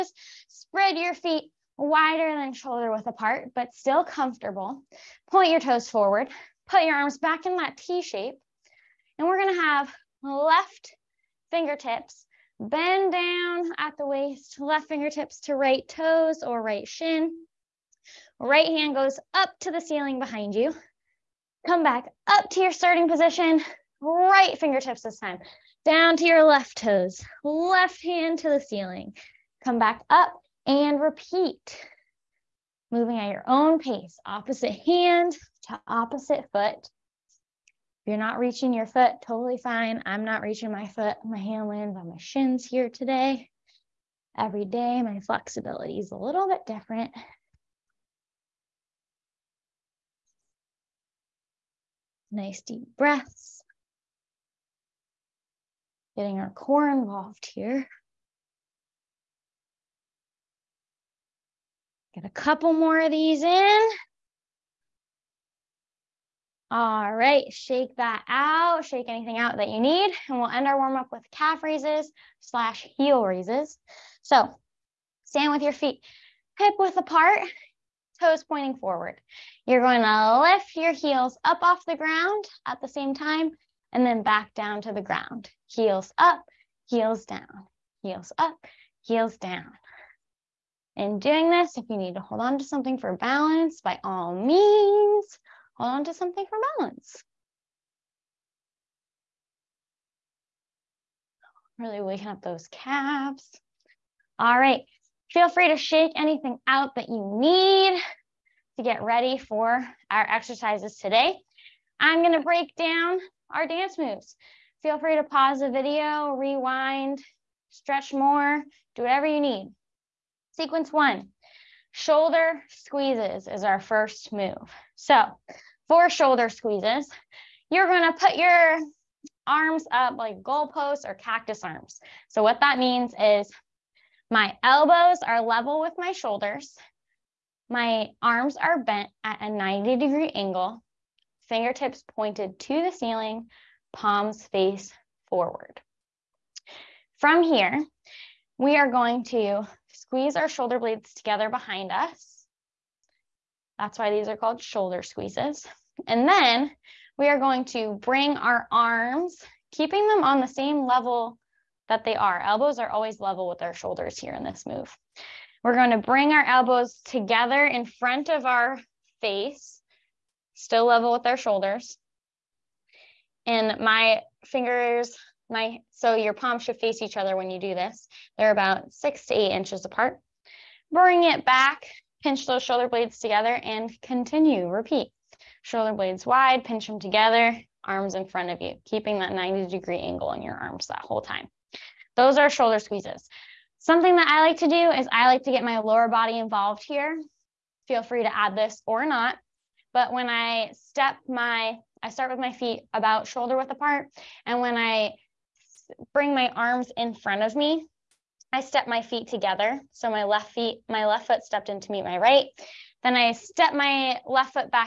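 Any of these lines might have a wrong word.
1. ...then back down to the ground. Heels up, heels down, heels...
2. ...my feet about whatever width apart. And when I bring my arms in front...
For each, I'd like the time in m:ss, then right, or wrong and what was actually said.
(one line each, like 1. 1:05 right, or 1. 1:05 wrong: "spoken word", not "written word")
1. 1:24 right
2. 3:22 wrong: "shoulder", not "whatever".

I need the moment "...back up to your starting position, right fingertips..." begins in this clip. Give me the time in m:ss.
0:21.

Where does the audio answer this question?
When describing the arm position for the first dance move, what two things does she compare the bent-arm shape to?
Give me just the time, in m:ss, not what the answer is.
2:10.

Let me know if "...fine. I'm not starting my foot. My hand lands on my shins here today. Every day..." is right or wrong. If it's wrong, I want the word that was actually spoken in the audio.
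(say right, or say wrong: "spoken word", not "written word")
wrong: "reaching", not "starting".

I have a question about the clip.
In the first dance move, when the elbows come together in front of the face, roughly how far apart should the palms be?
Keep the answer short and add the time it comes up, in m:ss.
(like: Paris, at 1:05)
6 to 8 inches, at 2:58.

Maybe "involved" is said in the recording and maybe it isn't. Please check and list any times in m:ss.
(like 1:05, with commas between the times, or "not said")
0:56, 3:16.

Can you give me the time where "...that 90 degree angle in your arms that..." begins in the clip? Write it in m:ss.
3:09.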